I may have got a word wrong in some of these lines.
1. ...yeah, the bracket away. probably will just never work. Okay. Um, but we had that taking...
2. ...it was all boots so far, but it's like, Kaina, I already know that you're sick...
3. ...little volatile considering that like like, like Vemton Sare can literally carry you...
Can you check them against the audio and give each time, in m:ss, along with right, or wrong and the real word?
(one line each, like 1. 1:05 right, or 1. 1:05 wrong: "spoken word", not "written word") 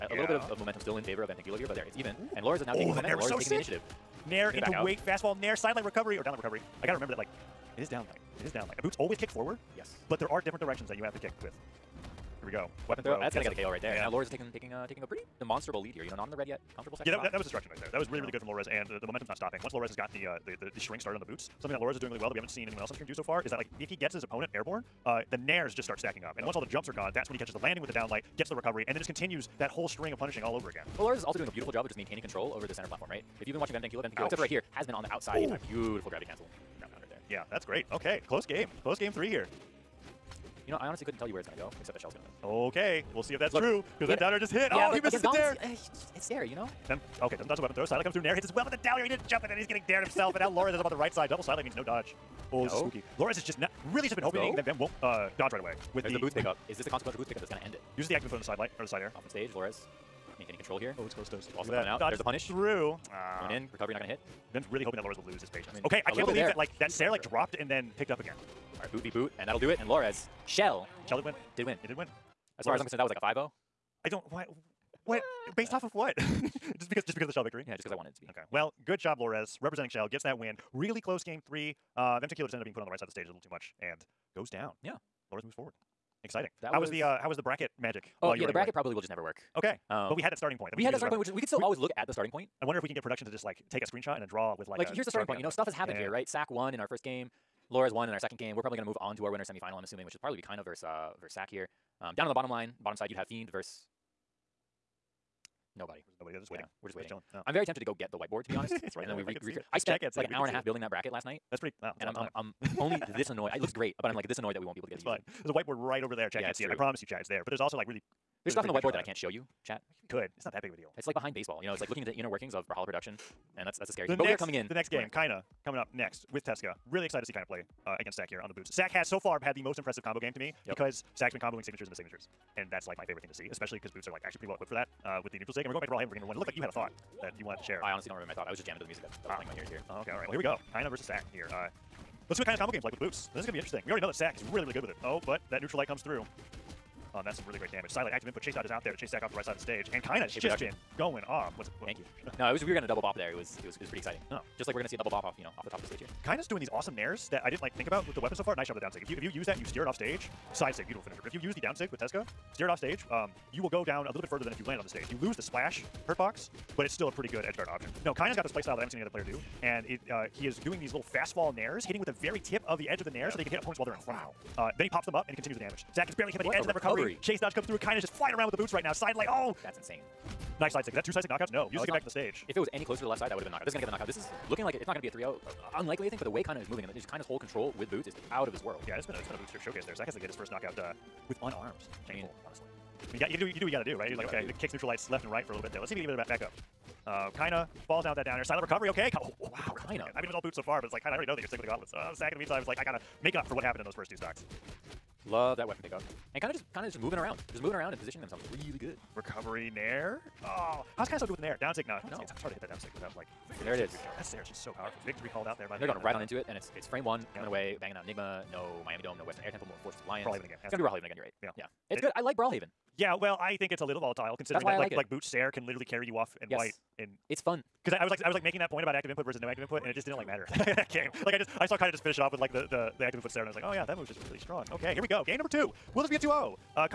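1. 1:28 wrong: "starting", not "taking"
2. 3:20 right
3. 3:43 wrong: "Boots", not "Vemton".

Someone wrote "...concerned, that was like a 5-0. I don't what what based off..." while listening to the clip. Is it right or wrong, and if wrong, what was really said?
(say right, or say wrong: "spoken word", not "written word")
right.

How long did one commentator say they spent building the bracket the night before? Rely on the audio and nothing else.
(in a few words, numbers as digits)
An hour and a half.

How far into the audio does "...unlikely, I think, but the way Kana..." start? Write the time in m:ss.
3:05.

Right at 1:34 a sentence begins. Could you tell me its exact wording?
Like here's the starting Sharpie point.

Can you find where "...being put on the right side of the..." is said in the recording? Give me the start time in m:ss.
1:22.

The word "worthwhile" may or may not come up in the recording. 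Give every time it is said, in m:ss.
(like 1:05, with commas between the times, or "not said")
not said.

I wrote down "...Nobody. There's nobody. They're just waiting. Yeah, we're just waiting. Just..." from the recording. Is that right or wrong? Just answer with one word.
right.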